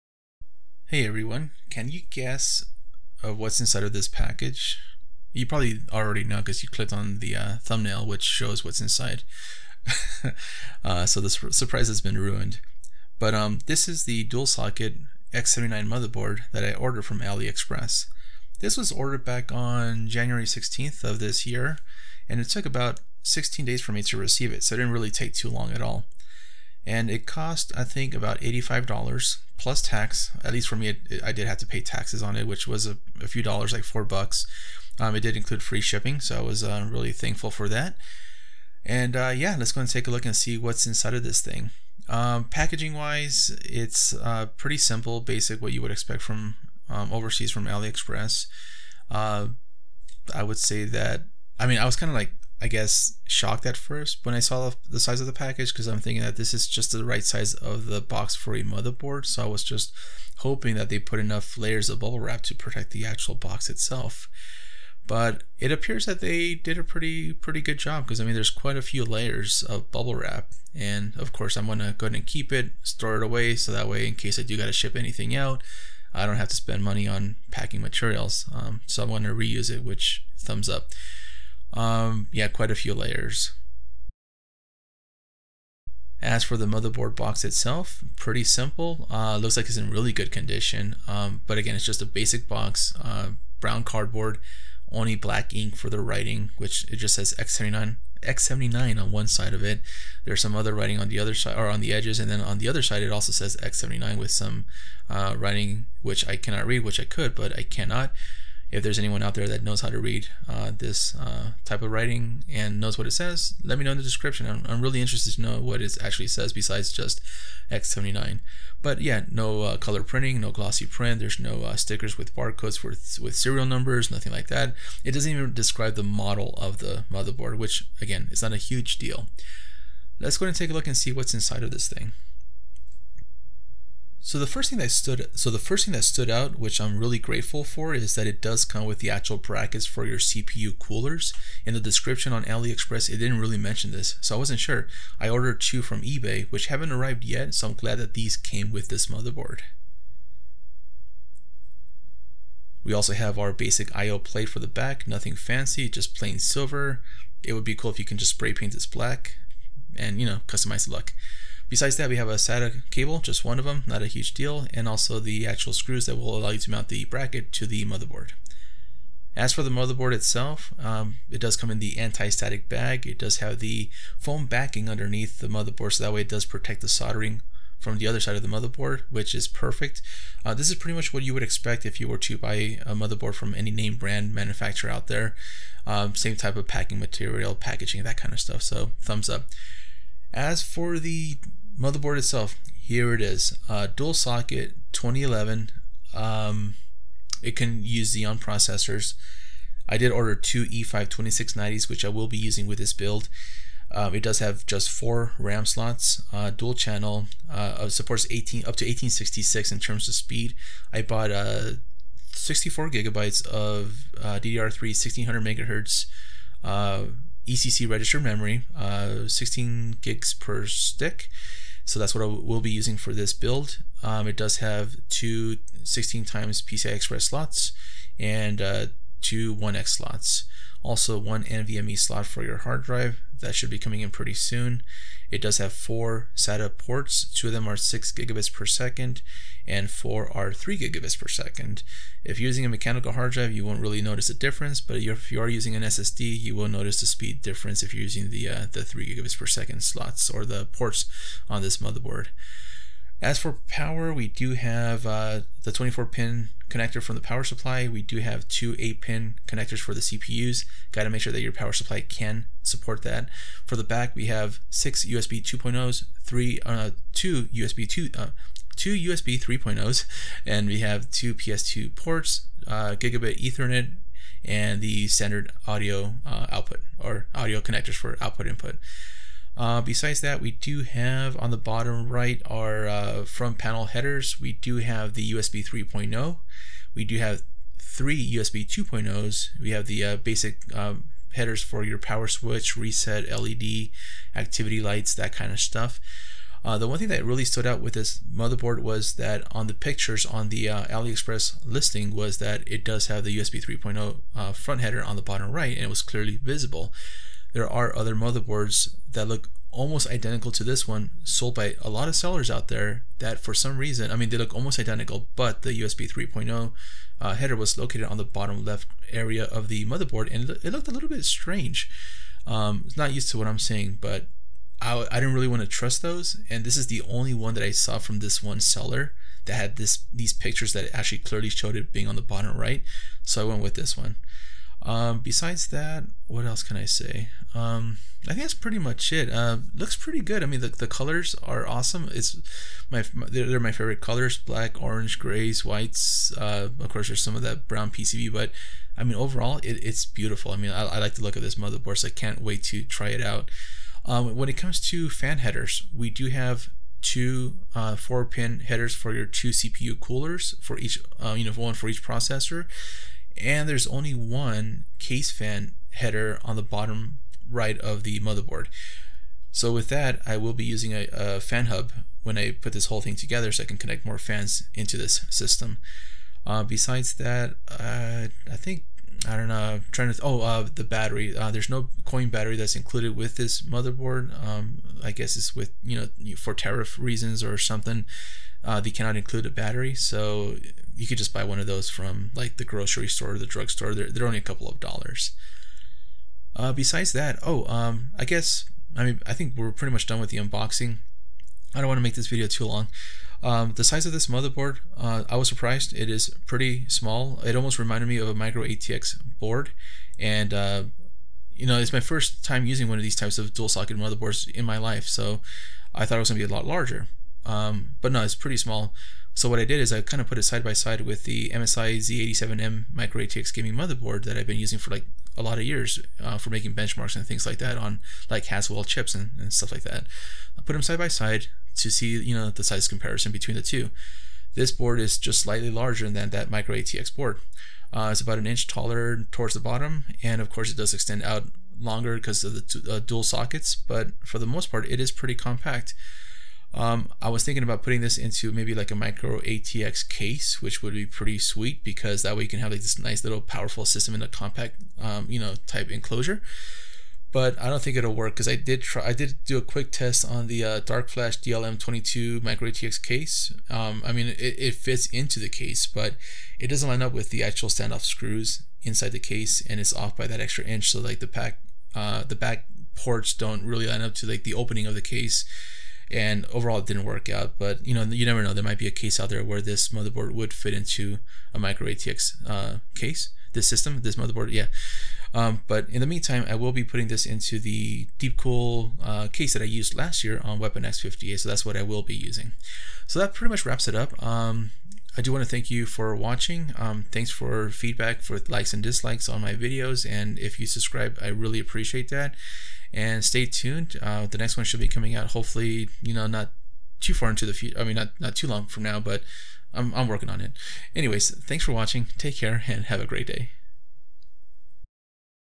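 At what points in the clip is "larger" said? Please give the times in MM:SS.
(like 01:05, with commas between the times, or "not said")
06:56, 07:15.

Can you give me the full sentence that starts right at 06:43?
Um, the size of this motherboard, uh, I was surprised.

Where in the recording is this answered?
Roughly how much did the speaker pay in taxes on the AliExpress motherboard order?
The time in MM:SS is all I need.
00:33.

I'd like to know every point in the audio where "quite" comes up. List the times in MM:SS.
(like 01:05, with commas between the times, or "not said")
01:08, 01:22.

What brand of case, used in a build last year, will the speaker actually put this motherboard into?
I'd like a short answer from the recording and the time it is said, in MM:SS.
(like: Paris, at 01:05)
Deepcool, at 08:08.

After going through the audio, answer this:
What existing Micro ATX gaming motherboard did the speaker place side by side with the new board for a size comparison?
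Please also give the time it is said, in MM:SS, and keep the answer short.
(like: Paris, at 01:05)
MSI Z87M, at 07:01.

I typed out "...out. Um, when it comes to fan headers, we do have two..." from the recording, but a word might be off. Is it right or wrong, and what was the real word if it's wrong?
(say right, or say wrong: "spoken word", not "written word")
right.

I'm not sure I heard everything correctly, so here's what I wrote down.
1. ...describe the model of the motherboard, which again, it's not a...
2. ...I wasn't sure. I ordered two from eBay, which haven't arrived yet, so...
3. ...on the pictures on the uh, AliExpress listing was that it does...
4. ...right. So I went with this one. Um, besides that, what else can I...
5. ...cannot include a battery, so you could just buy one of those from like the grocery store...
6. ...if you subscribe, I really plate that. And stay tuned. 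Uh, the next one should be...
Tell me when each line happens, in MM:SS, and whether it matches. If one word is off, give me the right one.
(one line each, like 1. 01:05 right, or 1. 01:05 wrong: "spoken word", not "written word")
1. 02:05 right
2. 02:24 right
3. 04:59 right
4. 05:32 right
5. 06:28 right
6. 08:20 wrong: "appreciate", not "plate".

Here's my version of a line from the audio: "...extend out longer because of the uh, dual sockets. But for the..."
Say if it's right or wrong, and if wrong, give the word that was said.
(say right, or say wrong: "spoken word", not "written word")
right.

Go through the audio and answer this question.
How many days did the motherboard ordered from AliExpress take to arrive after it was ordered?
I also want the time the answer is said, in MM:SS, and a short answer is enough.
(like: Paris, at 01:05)
16 days, at 00:23.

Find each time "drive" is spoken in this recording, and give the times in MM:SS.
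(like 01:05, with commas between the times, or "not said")
03:52, 04:03.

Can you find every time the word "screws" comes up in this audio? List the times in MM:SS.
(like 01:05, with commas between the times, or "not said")
02:45, 07:48.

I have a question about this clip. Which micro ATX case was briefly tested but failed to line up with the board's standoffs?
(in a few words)
Dark Flash DLM22.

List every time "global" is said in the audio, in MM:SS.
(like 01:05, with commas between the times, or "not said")
not said.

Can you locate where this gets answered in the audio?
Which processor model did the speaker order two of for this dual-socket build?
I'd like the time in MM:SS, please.
03:20.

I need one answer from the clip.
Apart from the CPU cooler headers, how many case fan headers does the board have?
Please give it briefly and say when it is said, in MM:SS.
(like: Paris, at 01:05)
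1, at 06:03.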